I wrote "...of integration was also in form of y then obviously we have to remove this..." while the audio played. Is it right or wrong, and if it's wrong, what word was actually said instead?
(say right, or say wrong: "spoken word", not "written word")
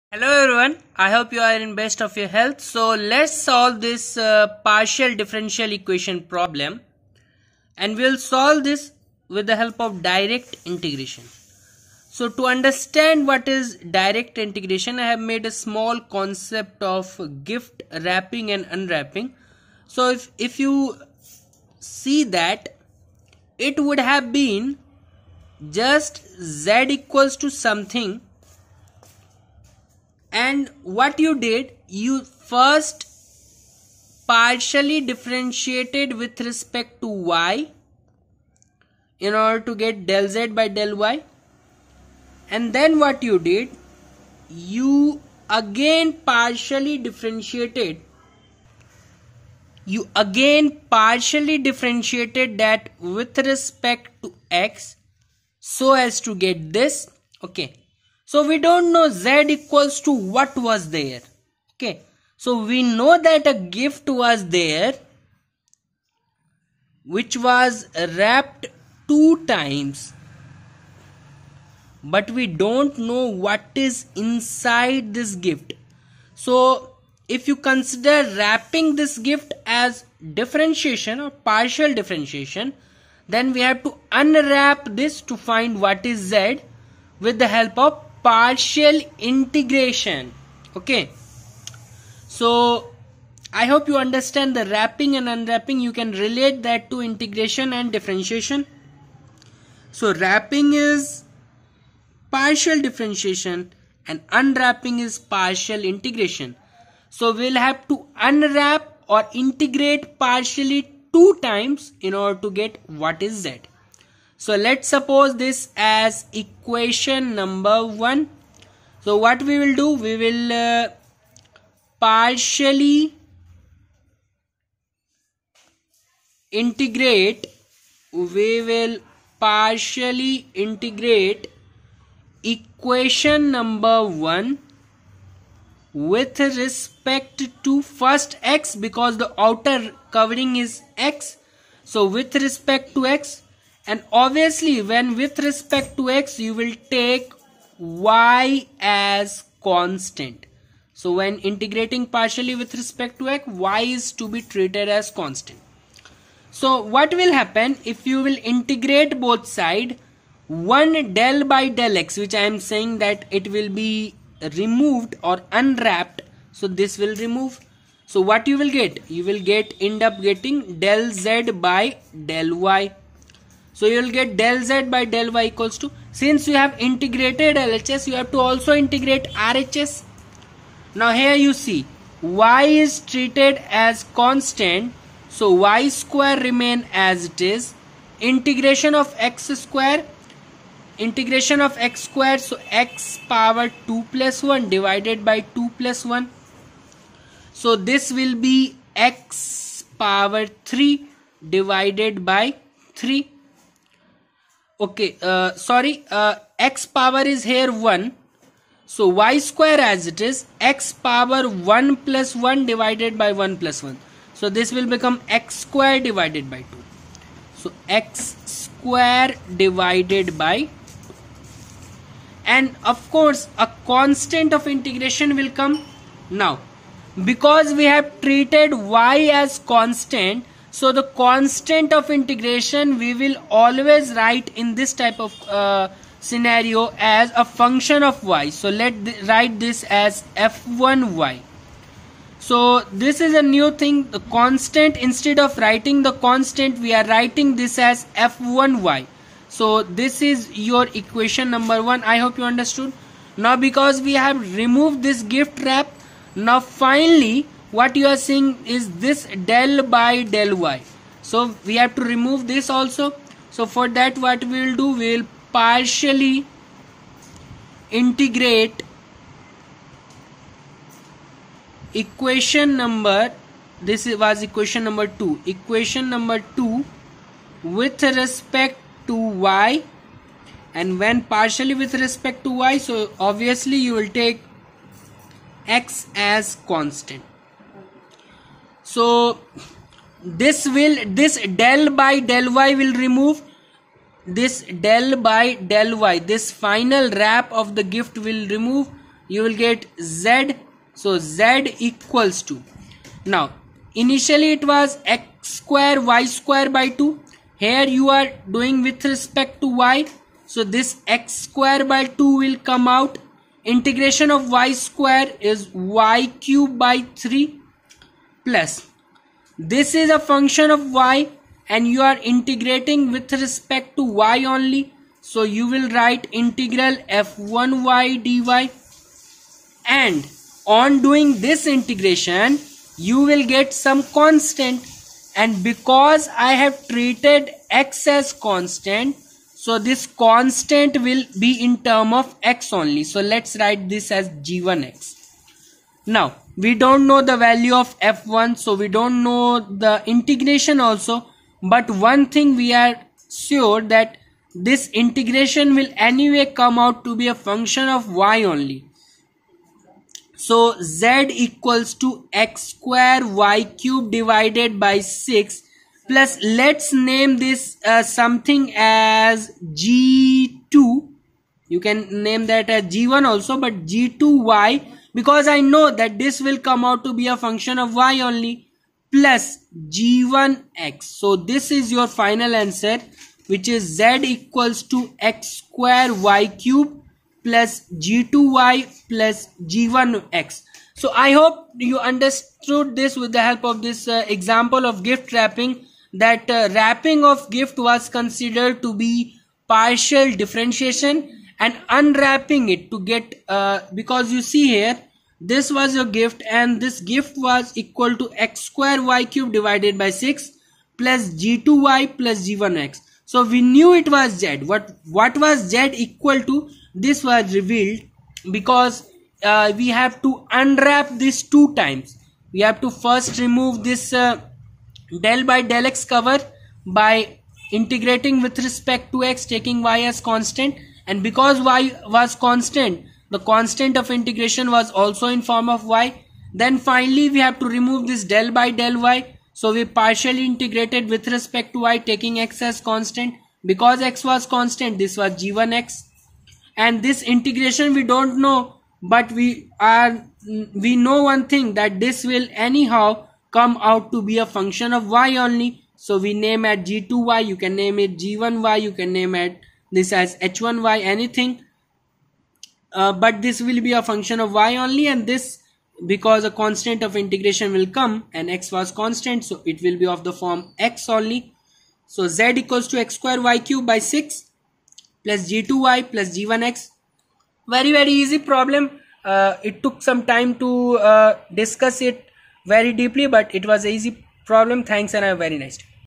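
wrong: "finally", not "obviously".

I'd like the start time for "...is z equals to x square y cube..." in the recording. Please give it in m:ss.
6:23.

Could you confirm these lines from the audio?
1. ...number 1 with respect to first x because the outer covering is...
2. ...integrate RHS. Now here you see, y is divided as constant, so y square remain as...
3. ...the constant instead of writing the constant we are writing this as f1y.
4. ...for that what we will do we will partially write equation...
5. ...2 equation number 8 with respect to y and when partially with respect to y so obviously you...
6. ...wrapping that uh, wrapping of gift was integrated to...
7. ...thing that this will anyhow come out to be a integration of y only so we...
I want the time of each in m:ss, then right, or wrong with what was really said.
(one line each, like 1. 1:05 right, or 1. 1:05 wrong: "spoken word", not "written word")
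1. 2:13 right
2. 2:58 wrong: "treated", not "divided"
3. 4:04 right
4. 4:23 wrong: "integrate", not "write"
5. 4:35 wrong: "2", not "8"
6. 6:35 wrong: "considered", not "integrated"
7. 7:31 wrong: "function", not "integration".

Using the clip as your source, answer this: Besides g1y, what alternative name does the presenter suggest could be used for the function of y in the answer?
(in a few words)
h1y.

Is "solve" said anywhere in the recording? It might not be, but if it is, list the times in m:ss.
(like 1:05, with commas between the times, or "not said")
0:03, 0:08.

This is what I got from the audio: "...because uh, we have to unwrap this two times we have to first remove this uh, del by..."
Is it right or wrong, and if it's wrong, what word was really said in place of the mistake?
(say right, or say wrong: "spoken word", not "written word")
right.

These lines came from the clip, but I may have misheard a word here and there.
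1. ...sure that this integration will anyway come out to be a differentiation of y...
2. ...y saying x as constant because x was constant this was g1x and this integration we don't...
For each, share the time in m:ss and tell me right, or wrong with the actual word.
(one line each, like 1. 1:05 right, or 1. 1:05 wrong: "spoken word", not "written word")
1. 5:53 wrong: "function", not "differentiation"
2. 7:21 wrong: "taking", not "saying".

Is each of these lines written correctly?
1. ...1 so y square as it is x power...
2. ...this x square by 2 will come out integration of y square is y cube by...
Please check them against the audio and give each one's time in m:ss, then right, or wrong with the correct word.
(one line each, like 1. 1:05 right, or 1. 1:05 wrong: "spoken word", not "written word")
1. 3:27 right
2. 5:10 right.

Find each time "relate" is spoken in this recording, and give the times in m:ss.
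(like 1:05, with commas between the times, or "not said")
1:36.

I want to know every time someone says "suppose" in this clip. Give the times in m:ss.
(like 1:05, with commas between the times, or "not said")
1:54.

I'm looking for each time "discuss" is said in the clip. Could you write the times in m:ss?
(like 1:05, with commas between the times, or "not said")
8:01.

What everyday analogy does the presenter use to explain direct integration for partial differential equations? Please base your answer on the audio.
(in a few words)
Gift wrapping and unwrapping.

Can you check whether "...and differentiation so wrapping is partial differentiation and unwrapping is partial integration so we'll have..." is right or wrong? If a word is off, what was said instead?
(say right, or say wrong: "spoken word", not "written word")
right.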